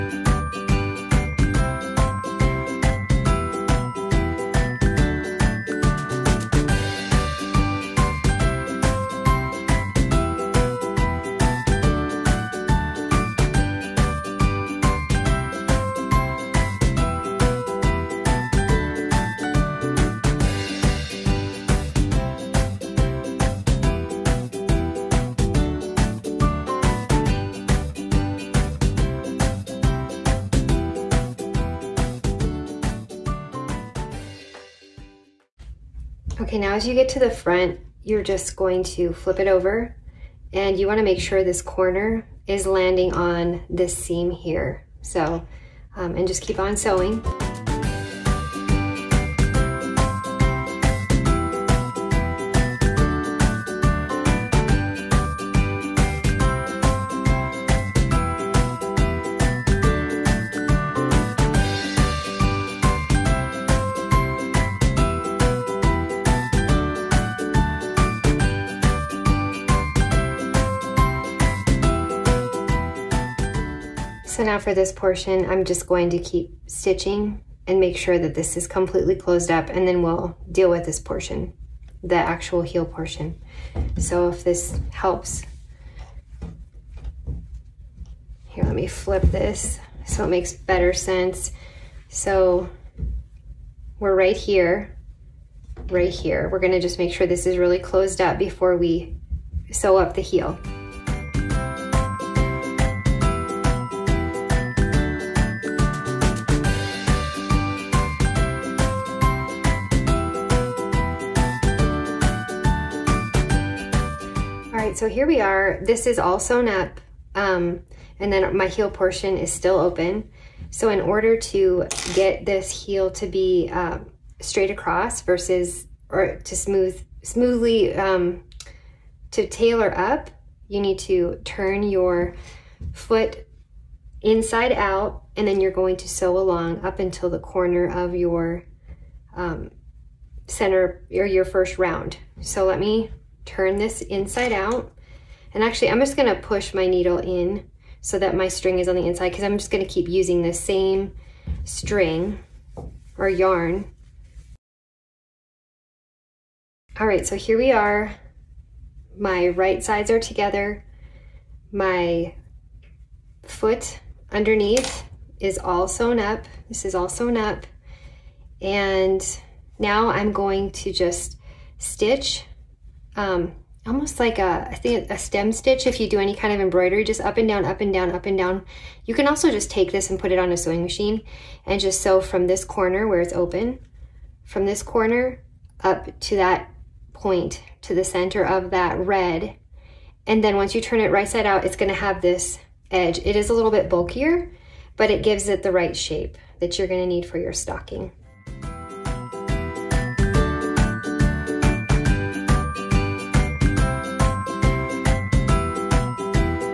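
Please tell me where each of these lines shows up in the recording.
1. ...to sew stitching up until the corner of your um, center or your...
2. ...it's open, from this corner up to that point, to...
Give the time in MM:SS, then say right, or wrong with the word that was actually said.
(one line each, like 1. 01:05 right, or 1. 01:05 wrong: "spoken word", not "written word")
1. 02:15 wrong: "along", not "stitching"
2. 03:03 right.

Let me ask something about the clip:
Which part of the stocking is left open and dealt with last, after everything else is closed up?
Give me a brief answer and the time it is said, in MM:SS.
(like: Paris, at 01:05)
the heel, at 01:22.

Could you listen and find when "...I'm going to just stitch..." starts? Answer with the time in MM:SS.
02:50.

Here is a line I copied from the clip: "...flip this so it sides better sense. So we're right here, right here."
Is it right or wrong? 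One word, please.
wrong.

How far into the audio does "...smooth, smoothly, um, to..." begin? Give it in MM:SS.
02:06.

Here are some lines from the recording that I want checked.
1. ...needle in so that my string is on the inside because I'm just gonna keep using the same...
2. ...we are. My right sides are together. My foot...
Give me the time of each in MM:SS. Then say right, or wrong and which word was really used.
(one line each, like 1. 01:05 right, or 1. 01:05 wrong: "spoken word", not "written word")
1. 02:26 right
2. 02:37 right.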